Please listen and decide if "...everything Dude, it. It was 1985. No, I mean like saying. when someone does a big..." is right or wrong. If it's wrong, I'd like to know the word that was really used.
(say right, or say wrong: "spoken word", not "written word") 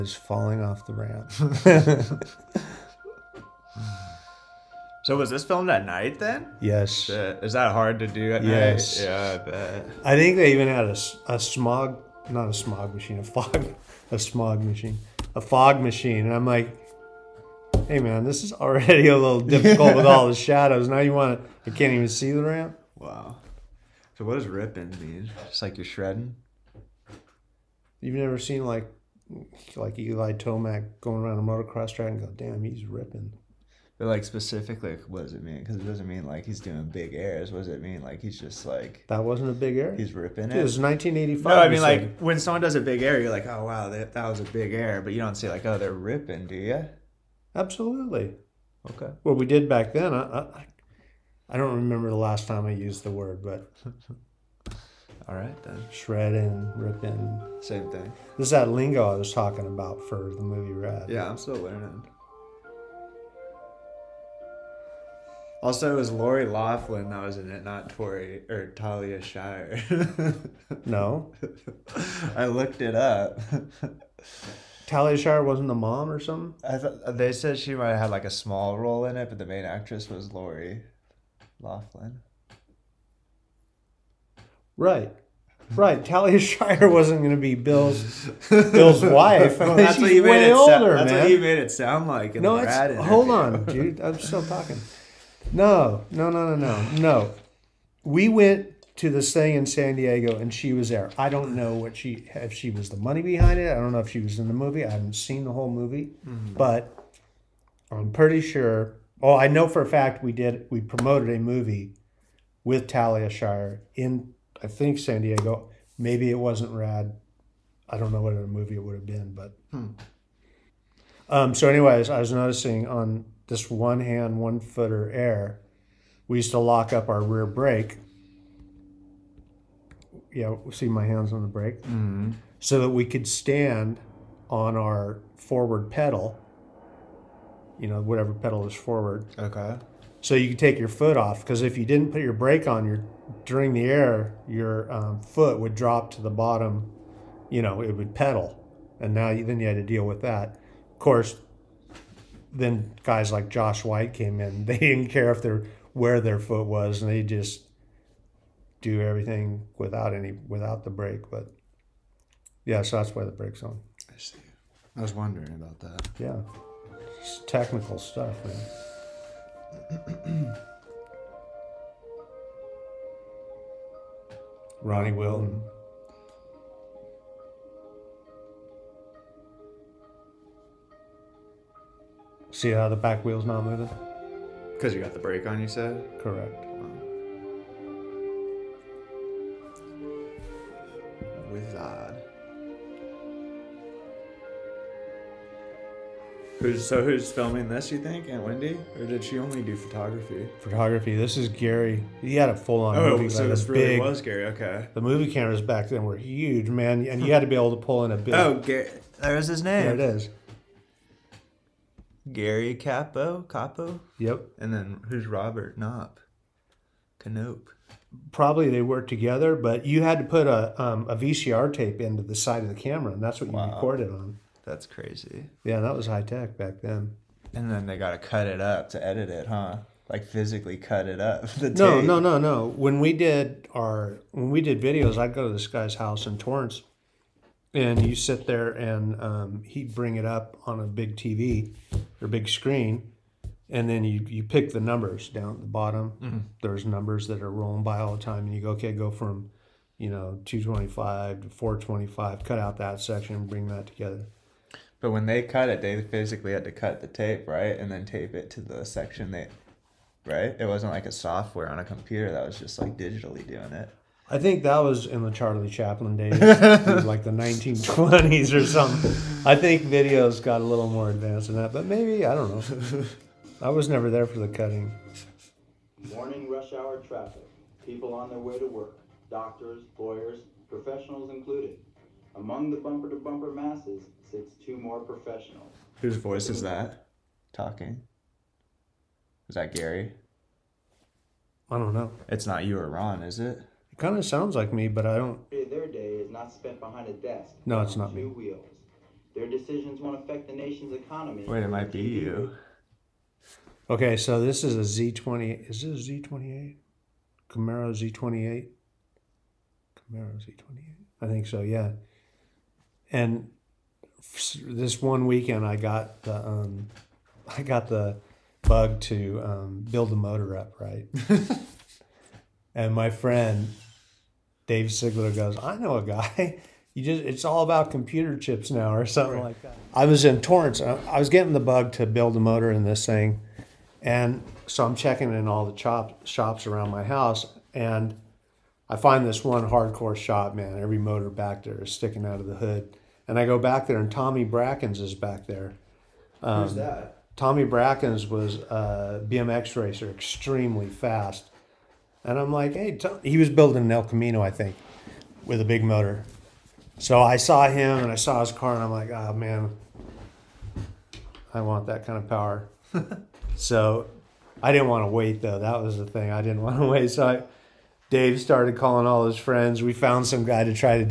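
wrong: "ripping", not "everything".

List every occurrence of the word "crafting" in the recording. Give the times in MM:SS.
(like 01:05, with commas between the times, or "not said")
not said.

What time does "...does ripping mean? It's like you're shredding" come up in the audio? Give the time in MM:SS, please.
00:24.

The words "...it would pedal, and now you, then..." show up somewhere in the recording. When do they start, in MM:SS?
02:27.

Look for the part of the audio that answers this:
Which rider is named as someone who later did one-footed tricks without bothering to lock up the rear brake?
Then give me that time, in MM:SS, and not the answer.
02:33.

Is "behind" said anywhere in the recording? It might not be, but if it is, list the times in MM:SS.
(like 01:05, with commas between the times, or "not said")
01:43, 04:56.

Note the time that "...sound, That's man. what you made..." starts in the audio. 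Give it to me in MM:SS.
01:30.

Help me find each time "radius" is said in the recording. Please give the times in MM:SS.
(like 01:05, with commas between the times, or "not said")
not said.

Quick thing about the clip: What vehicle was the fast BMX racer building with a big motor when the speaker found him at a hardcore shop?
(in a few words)
El Camino.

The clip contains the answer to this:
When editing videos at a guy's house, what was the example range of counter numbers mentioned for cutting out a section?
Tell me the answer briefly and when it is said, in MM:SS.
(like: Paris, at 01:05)
225 to 425, at 04:10.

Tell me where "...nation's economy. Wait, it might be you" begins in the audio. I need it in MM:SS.
05:00.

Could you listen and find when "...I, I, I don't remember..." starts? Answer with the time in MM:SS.
00:50.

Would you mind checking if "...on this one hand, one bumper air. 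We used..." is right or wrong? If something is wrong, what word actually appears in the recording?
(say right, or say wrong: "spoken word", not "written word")
wrong: "footer", not "bumper".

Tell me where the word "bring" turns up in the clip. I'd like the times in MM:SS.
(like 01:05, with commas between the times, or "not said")
03:59, 04:13.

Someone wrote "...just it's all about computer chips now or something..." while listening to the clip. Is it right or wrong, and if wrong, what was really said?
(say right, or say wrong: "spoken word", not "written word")
right.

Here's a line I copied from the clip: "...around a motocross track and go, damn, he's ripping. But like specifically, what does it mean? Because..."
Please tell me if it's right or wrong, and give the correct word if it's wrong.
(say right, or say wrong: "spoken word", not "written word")
right.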